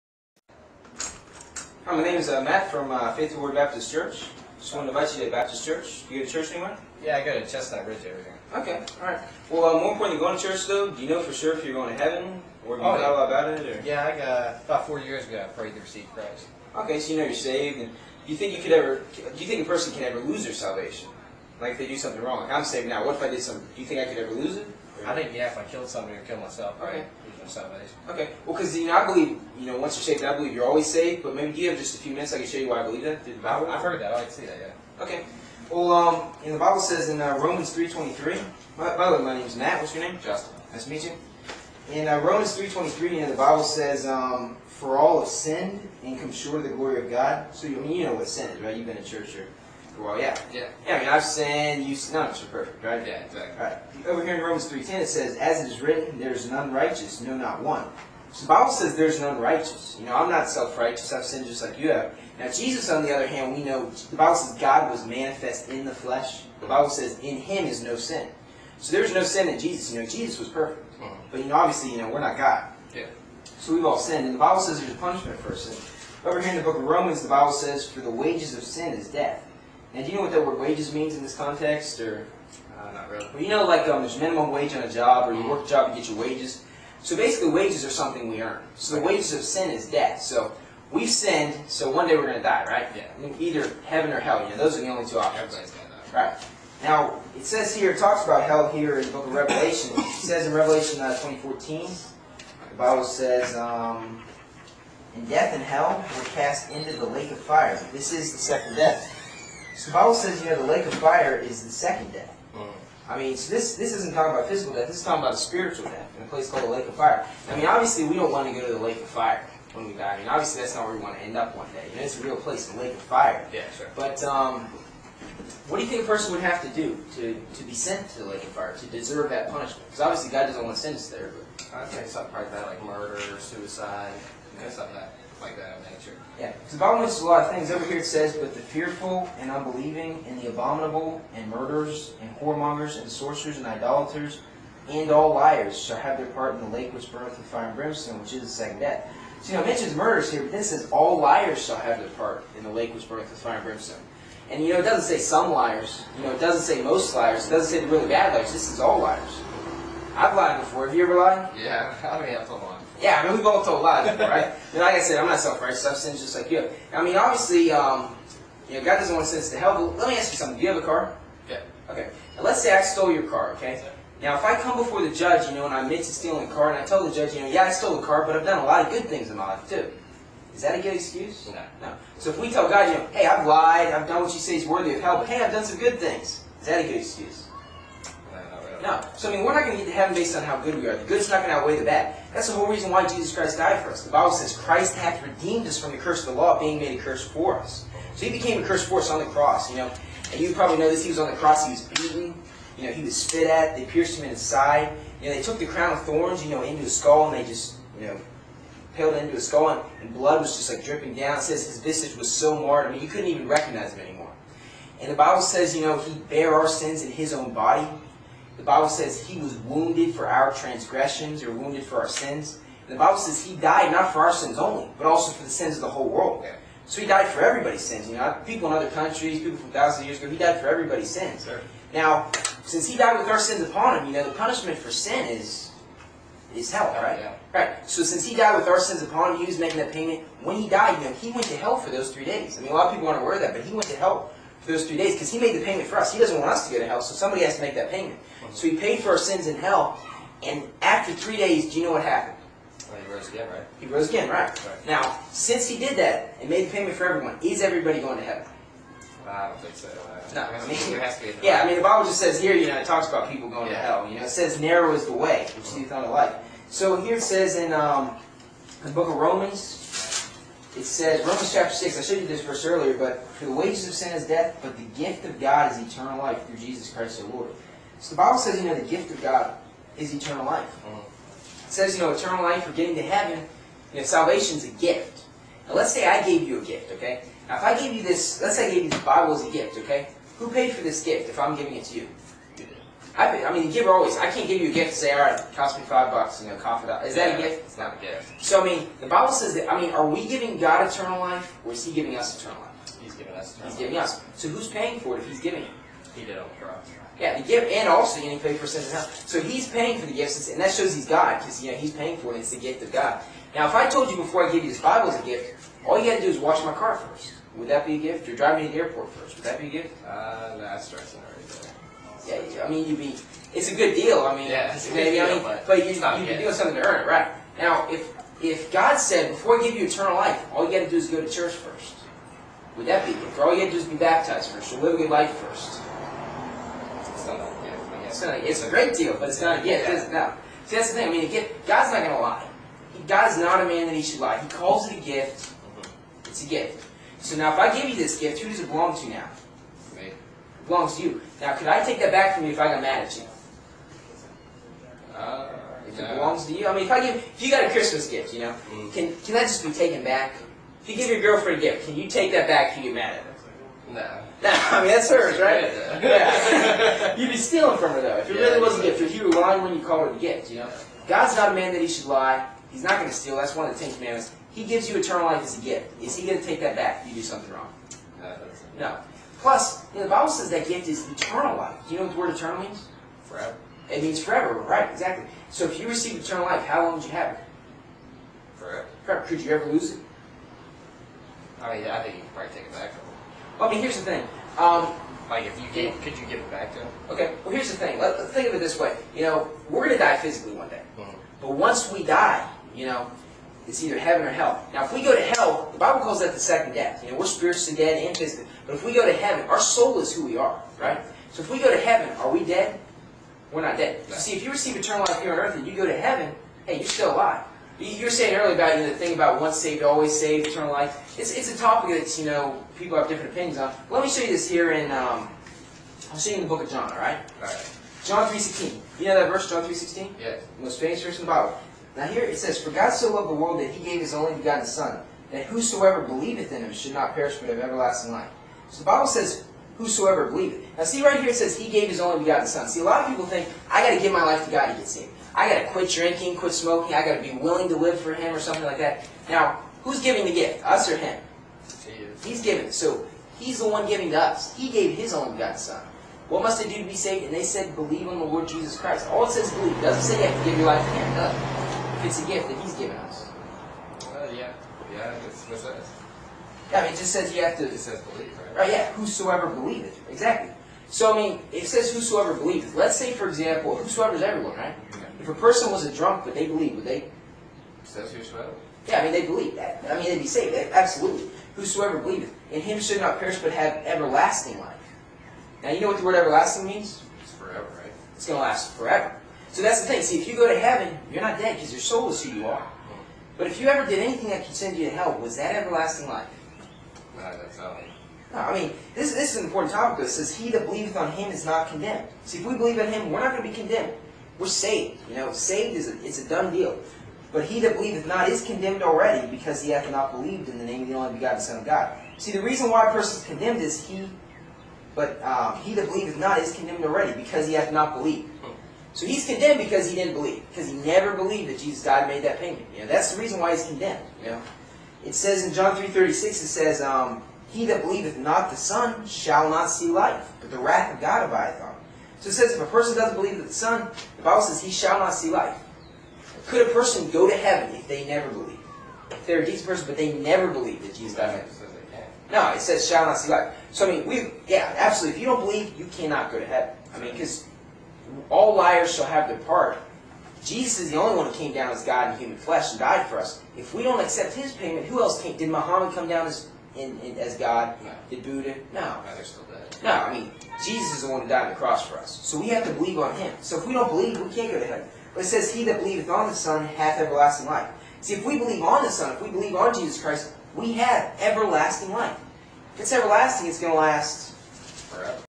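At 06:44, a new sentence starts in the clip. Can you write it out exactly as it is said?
Now, if we go to hell, the Bible calls that the second death.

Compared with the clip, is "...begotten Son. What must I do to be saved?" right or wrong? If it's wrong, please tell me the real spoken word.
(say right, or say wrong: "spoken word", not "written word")
right.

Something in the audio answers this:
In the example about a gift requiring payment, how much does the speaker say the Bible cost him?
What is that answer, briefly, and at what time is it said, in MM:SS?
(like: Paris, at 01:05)
5 bucks, at 04:55.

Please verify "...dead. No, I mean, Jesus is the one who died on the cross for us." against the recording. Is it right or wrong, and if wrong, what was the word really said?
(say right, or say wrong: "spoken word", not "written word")
right.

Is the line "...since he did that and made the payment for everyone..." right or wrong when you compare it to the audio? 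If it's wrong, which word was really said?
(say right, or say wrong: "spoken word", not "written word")
right.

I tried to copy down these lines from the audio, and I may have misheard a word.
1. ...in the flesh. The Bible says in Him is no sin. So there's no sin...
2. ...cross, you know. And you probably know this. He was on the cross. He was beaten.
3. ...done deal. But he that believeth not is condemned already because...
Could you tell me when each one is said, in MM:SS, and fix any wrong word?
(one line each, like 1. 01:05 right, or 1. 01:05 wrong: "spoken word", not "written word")
1. 01:05 right
2. 03:19 right
3. 08:26 right.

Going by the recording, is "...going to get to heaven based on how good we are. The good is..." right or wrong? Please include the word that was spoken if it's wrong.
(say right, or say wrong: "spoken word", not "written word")
right.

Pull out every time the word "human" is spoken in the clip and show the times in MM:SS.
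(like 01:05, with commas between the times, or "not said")
09:12.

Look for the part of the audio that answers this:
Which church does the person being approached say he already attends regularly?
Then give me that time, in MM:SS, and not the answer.
00:07.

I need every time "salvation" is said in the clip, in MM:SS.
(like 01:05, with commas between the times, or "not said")
00:20, 04:44.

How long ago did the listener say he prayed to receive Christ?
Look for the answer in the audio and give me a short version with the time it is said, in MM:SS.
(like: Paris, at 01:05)
4 years ago, at 00:14.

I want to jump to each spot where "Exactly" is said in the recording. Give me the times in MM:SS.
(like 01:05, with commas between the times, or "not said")
00:53, 06:24, 07:50.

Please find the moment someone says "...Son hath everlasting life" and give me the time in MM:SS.
09:26.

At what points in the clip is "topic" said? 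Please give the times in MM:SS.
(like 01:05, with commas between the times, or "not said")
07:01, 08:19.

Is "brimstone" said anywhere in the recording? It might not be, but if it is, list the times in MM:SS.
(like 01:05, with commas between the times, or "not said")
02:27, 02:33.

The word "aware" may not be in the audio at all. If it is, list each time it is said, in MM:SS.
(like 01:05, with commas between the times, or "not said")
04:03.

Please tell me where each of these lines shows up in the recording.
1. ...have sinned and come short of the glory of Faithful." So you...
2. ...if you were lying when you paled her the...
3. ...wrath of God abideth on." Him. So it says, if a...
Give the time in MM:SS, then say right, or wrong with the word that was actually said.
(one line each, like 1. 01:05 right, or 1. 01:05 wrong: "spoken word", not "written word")
1. 00:45 wrong: "God", not "Faithful"
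2. 06:08 wrong: "called", not "paled"
3. 08:50 right.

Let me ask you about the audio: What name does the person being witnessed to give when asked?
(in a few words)
Justin.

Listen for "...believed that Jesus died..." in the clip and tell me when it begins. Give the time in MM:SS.
08:41.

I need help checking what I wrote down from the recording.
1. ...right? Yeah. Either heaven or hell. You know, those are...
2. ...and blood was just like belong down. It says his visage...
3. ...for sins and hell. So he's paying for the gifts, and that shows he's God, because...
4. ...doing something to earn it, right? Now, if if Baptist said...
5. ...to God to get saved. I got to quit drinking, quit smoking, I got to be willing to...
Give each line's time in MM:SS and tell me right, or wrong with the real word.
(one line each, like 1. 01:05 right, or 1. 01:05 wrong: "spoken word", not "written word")
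1. 01:32 right
2. 03:30 wrong: "dripping", not "belong"
3. 05:08 right
4. 05:26 wrong: "God", not "Baptist"
5. 07:24 right.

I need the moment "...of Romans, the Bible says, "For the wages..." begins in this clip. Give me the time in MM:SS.
01:16.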